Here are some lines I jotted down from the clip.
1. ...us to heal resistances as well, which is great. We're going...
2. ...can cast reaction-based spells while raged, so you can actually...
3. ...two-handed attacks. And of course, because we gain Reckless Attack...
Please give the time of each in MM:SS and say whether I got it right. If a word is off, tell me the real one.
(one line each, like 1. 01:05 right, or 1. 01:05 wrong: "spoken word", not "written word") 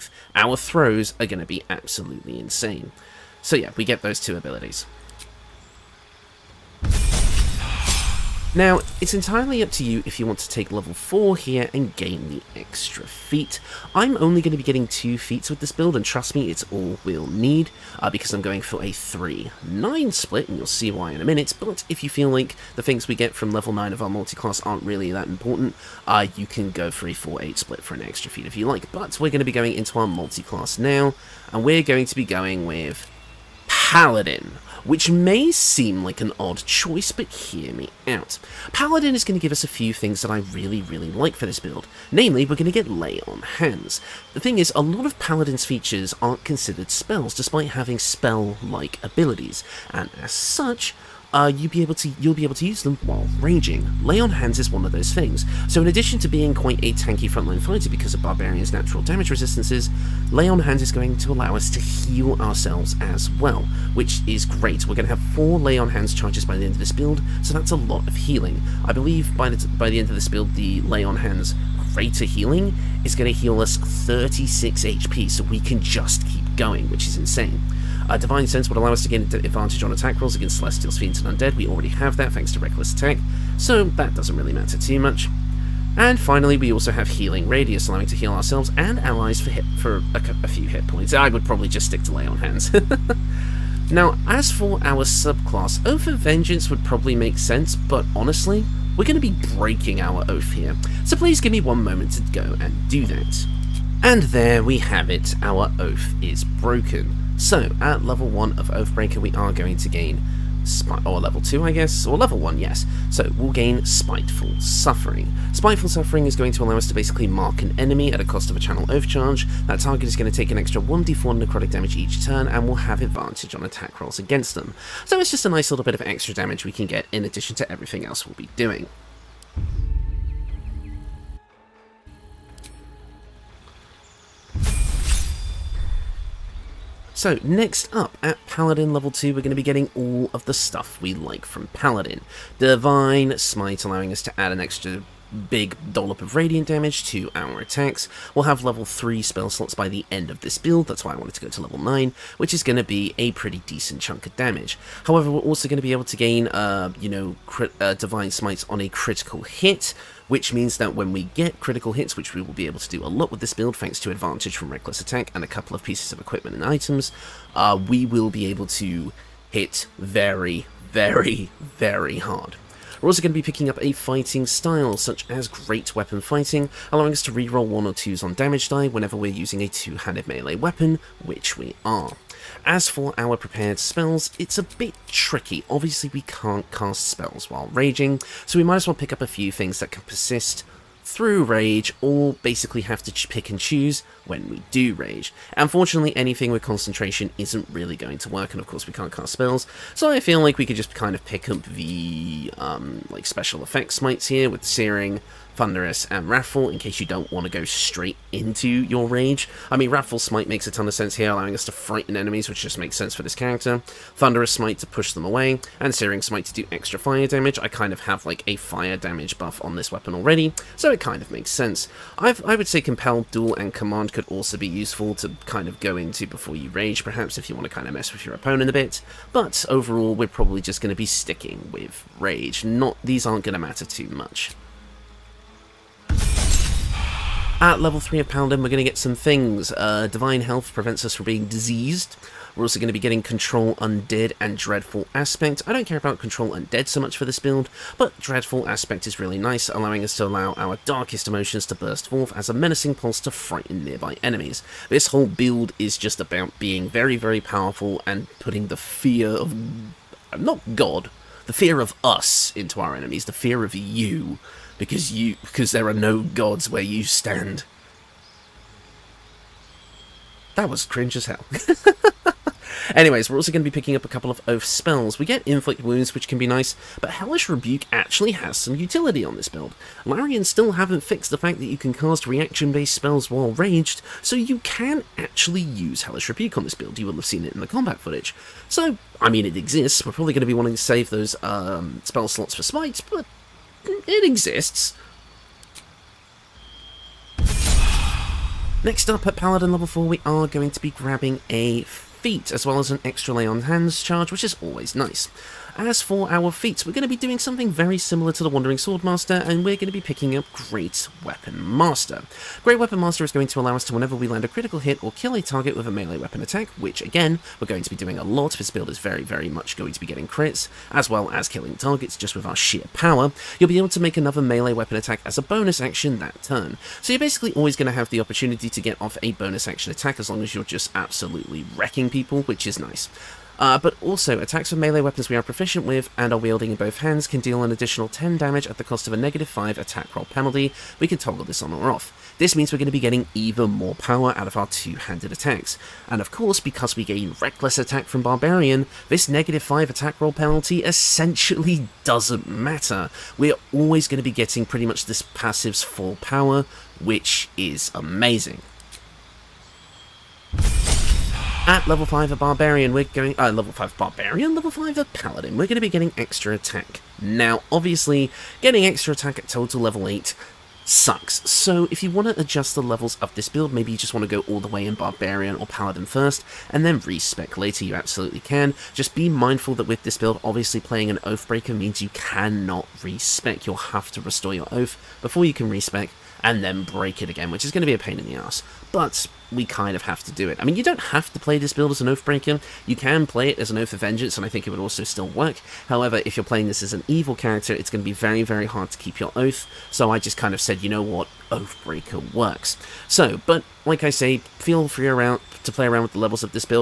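1. 01:01 wrong: "ourselves", not "resistances"
2. 04:41 right
3. 05:44 right.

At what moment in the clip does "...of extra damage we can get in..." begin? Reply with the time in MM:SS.
02:05.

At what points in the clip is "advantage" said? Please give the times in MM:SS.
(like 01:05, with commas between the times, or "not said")
01:19, 02:03, 02:44.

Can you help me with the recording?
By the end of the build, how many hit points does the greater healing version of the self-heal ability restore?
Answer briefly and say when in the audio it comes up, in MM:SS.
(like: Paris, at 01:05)
36, at 01:13.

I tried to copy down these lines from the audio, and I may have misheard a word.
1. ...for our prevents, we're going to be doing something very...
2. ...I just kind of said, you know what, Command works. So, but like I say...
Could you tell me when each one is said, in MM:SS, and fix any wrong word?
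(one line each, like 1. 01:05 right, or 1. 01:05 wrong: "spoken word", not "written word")
1. 05:06 wrong: "feats", not "prevents"
2. 06:40 wrong: "Oathbreaker", not "Command".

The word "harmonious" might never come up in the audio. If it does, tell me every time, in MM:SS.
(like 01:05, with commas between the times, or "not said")
not said.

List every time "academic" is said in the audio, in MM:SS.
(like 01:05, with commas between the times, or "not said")
not said.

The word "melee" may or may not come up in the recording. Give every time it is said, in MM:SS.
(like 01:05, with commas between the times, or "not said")
03:00, 05:15, 05:24, 05:34.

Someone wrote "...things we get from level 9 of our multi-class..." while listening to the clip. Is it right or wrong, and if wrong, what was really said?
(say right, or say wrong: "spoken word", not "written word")
right.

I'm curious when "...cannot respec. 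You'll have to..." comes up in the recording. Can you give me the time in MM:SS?
06:22.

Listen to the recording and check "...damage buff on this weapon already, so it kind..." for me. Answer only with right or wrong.
right.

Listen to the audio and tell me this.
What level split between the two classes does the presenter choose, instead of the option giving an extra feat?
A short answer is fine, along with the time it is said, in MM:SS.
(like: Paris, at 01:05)
3-9, at 00:18.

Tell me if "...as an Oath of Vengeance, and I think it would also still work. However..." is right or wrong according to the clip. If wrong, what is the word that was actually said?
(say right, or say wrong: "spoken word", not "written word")
right.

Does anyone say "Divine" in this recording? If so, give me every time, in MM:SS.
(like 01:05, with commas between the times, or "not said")
01:18, 02:22, 02:37, 04:00.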